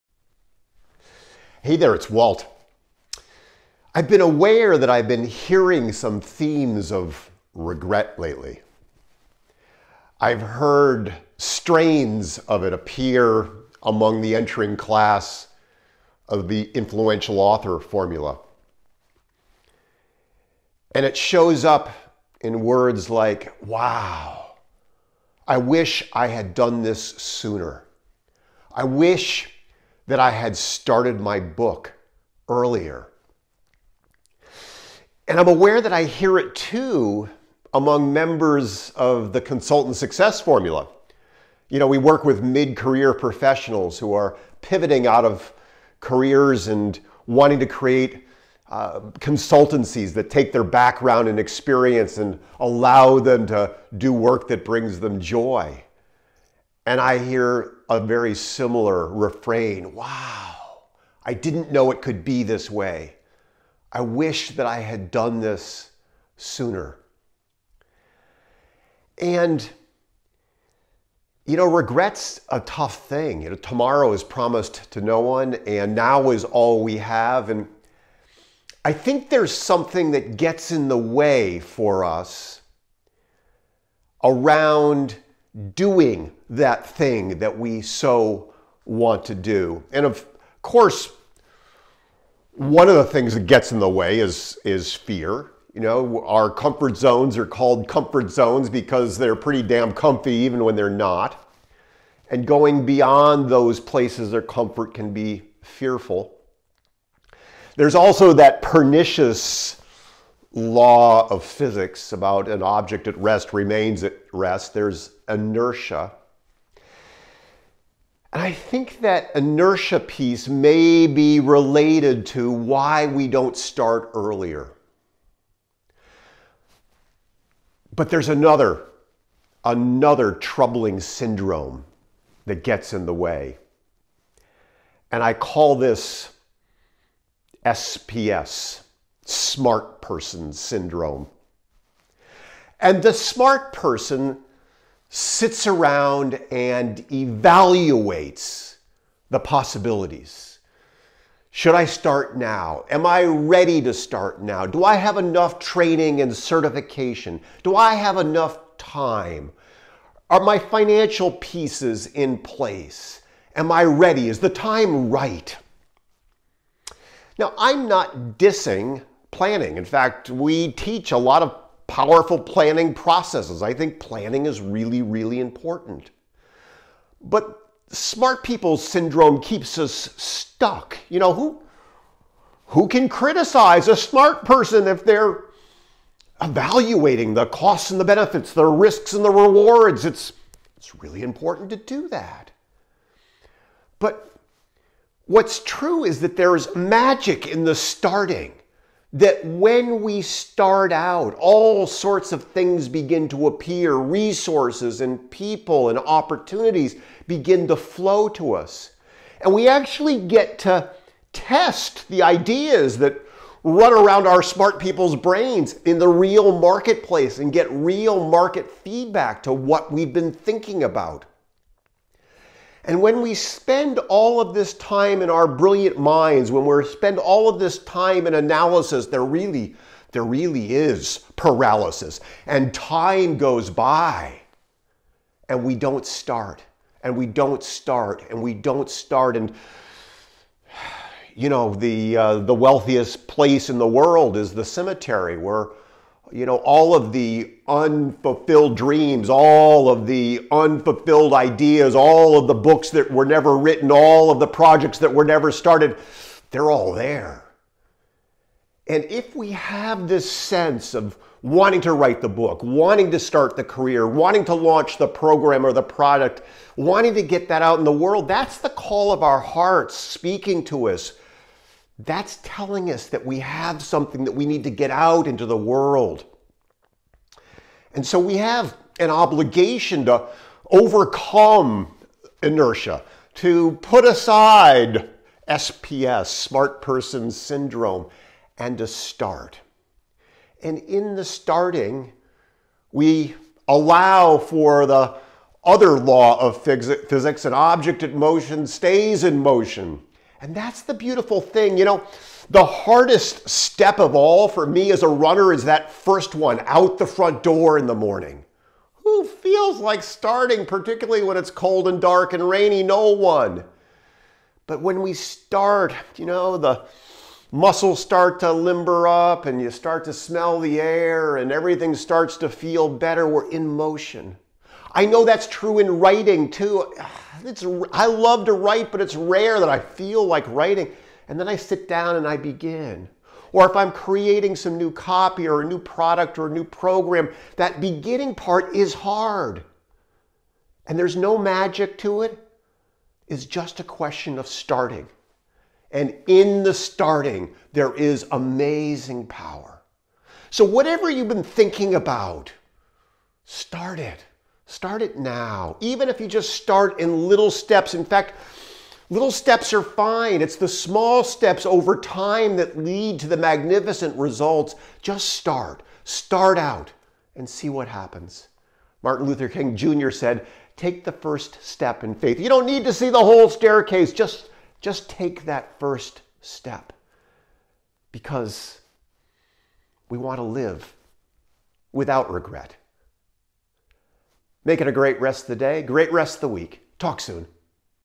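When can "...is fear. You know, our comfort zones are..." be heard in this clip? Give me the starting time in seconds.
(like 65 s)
94 s.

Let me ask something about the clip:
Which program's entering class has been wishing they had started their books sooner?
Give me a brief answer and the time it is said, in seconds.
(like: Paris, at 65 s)
influential author formula, at 16 s.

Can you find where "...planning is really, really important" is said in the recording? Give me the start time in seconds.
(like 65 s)
173 s.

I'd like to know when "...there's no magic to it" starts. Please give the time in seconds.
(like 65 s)
340 s.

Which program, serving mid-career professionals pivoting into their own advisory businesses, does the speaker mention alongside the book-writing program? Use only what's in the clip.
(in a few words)
consultant success formula.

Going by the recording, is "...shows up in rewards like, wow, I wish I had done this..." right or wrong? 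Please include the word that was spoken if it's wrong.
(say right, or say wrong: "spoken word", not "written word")
wrong: "words", not "rewards".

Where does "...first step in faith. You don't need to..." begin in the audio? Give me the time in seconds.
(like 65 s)
371 s.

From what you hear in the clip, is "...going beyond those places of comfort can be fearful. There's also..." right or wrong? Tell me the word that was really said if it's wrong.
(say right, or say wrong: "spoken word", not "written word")
right.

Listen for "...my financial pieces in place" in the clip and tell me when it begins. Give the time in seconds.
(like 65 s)
160 s.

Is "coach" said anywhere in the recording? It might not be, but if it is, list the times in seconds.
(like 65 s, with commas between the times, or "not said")
not said.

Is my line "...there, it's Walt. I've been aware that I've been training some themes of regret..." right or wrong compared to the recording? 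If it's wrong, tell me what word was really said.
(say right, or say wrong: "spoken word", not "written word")
wrong: "hearing", not "training".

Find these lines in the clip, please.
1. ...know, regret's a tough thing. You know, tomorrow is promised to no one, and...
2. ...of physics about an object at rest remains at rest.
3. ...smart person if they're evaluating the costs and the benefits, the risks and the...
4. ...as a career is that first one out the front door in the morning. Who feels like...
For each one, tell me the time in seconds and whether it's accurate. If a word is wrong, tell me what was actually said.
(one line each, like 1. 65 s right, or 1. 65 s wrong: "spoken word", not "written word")
1. 71 s right
2. 111 s right
3. 183 s right
4. 304 s wrong: "runner", not "career".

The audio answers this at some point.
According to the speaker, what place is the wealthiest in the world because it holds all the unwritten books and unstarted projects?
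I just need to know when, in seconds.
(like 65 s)
244 s.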